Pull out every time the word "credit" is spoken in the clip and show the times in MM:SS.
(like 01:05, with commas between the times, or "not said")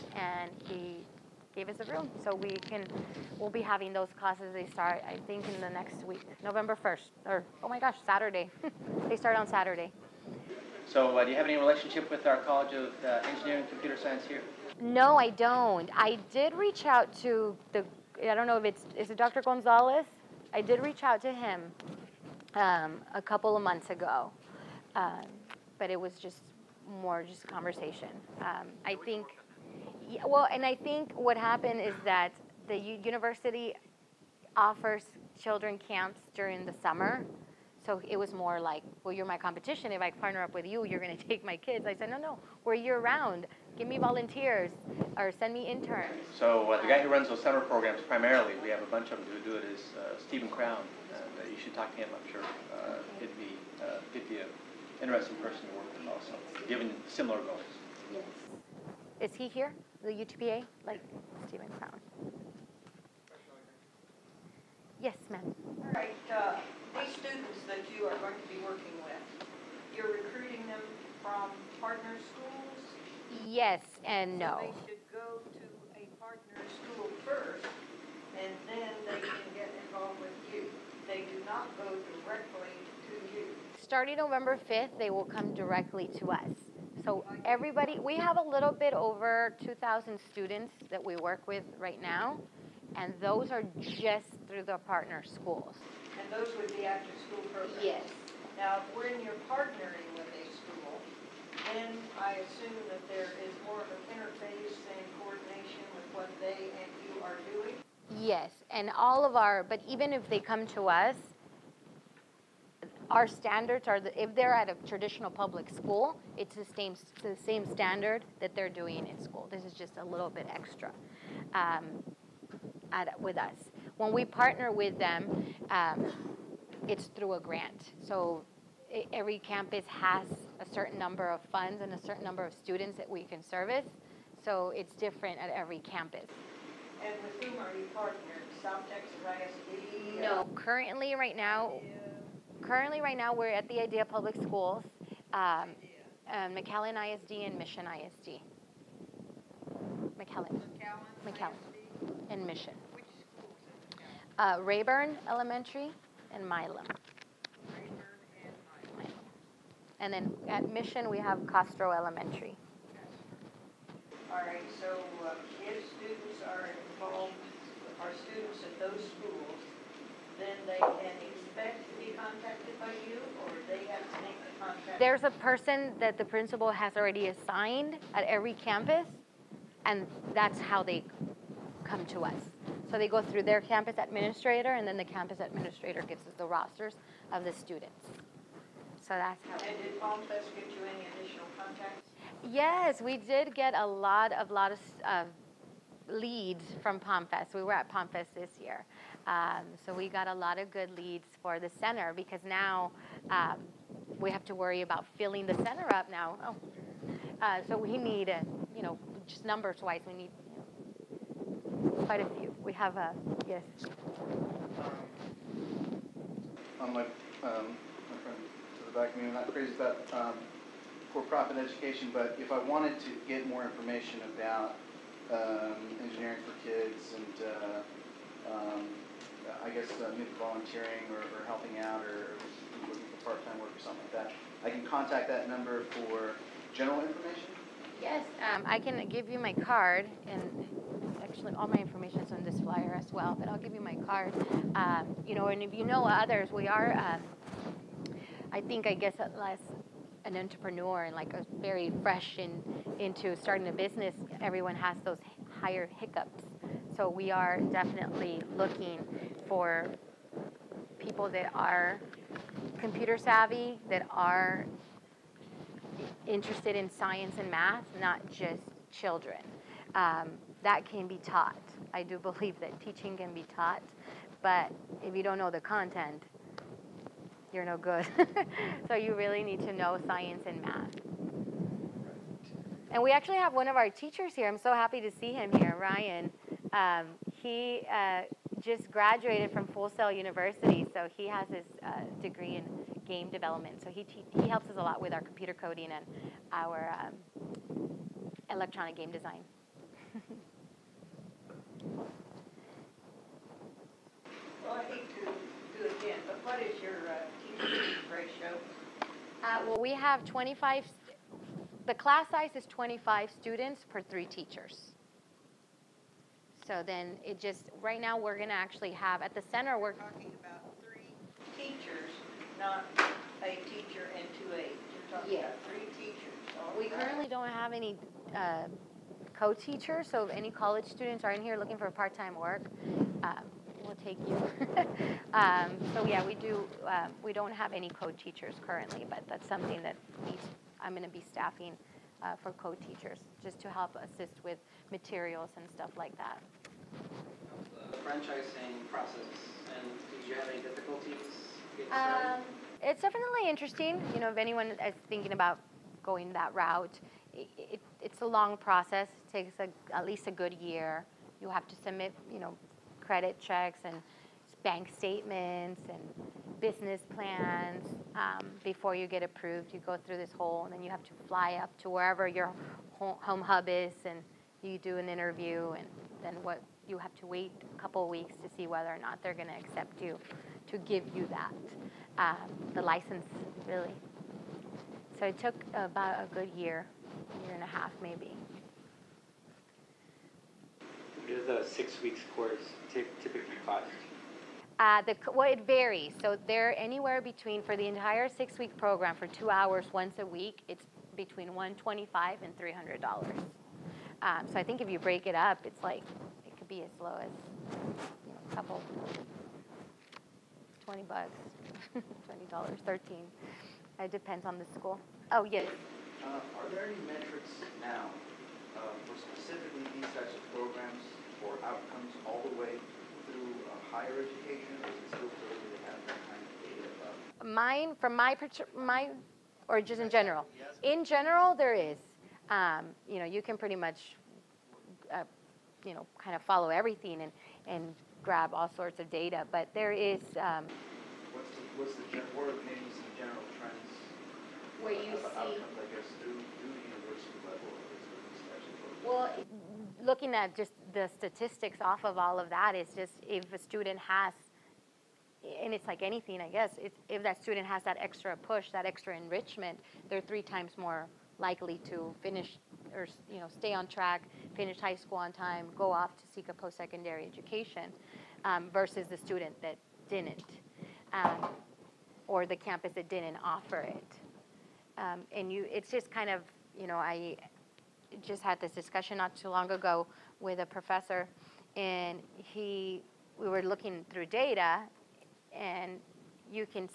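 06:03.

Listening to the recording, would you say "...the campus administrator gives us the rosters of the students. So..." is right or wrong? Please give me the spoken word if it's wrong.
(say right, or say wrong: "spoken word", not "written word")
right.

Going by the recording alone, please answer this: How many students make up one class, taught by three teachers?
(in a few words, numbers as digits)
25.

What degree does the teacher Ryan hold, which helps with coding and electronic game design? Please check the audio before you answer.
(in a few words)
game development.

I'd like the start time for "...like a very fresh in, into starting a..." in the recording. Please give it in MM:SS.
04:11.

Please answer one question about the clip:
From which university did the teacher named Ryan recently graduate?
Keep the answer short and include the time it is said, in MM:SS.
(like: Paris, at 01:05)
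Full Sail University, at 04:49.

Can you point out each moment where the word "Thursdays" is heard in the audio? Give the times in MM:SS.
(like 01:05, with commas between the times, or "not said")
not said.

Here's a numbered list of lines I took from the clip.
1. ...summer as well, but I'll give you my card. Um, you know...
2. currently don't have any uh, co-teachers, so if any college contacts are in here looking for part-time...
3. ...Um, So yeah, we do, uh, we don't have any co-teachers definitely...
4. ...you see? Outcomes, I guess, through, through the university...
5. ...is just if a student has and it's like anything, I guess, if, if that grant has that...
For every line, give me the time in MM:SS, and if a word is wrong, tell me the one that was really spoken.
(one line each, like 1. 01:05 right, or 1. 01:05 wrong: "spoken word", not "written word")
1. 04:02 wrong: "flyer", not "summer"
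2. 05:26 wrong: "students", not "contacts"
3. 05:35 wrong: "currently", not "definitely"
4. 07:24 right
5. 07:32 wrong: "student", not "grant".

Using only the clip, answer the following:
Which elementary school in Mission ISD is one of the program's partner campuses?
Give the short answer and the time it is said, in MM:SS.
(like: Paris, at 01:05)
Castro Elementary, at 02:41.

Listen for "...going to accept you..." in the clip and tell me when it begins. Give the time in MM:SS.
06:19.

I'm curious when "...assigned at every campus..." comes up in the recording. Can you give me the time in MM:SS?
02:57.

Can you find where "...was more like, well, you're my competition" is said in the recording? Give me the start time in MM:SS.
00:38.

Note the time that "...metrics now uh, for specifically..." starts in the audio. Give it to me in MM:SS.
06:57.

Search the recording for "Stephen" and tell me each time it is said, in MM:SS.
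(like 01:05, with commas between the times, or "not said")
00:50, 01:01.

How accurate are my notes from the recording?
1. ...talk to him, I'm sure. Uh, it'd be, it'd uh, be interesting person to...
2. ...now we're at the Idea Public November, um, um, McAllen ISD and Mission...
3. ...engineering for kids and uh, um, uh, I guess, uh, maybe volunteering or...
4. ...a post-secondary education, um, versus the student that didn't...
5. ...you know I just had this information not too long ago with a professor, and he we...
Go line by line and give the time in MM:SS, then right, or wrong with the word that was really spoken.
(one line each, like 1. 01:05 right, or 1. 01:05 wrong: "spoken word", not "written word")
1. 00:51 right
2. 02:23 wrong: "Schools", not "November"
3. 03:46 right
4. 07:46 right
5. 07:56 wrong: "discussion", not "information".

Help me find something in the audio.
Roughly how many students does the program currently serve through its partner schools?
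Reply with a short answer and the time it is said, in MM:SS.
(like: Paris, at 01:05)
2,000, at 01:29.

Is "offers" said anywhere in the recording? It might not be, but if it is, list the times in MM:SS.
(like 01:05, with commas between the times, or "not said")
00:34, 07:53.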